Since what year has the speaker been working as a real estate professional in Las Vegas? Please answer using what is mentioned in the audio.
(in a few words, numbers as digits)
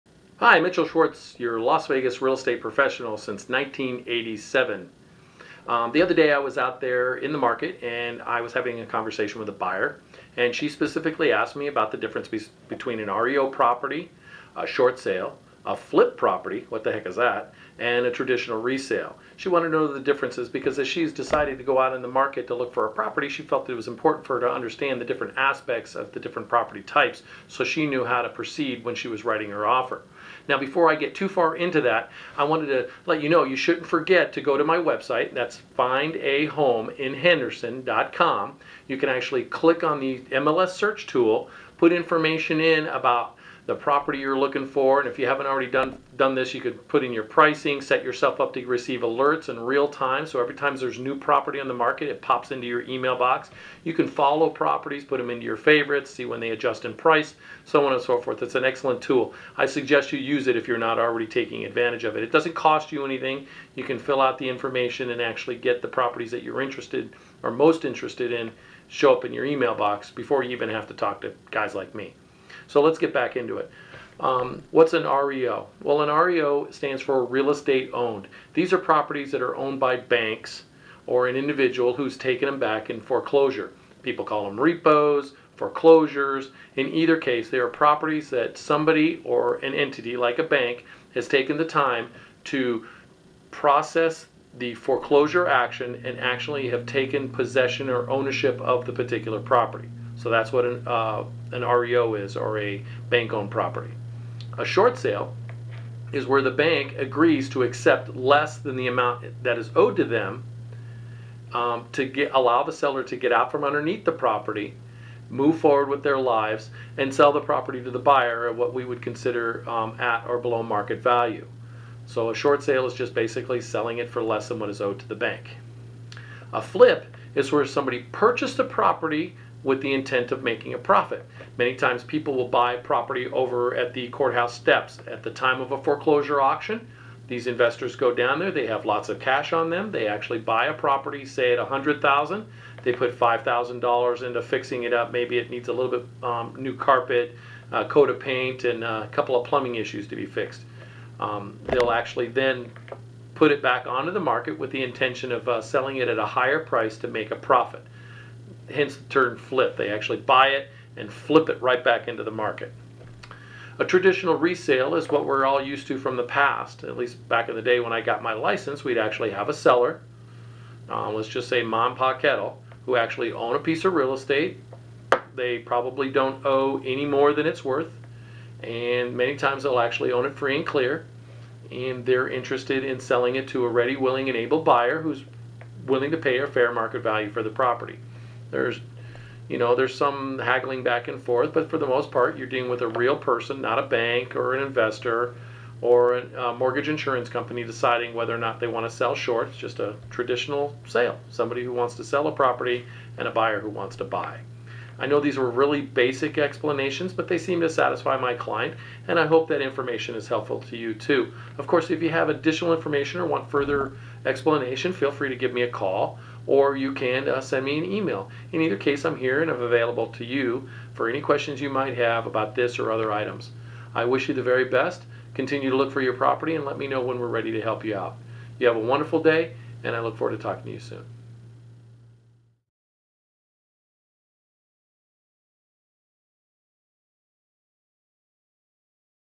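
1987.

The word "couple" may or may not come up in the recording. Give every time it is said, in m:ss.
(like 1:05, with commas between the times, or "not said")
2:29.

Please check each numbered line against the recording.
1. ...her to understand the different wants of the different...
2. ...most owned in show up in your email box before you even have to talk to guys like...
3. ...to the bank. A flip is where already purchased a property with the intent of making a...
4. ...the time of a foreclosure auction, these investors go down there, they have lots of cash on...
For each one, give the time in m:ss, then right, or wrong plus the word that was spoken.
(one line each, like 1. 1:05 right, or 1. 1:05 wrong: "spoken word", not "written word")
1. 0:24 wrong: "aspects", not "wants"
2. 1:07 wrong: "interested", not "owned"
3. 2:04 wrong: "somebody", not "already"
4. 2:15 right.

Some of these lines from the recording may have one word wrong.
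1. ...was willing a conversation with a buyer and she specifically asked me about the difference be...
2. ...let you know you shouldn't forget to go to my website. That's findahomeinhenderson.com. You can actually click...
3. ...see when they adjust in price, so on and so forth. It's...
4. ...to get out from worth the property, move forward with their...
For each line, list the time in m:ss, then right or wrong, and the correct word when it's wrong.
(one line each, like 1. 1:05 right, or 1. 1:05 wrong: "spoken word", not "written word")
1. 0:08 wrong: "having", not "willing"
2. 0:33 right
3. 0:56 right
4. 1:53 wrong: "underneath", not "worth".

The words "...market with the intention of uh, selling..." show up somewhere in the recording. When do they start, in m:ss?
2:34.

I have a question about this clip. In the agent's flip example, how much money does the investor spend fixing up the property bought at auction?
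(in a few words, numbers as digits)
$5,000.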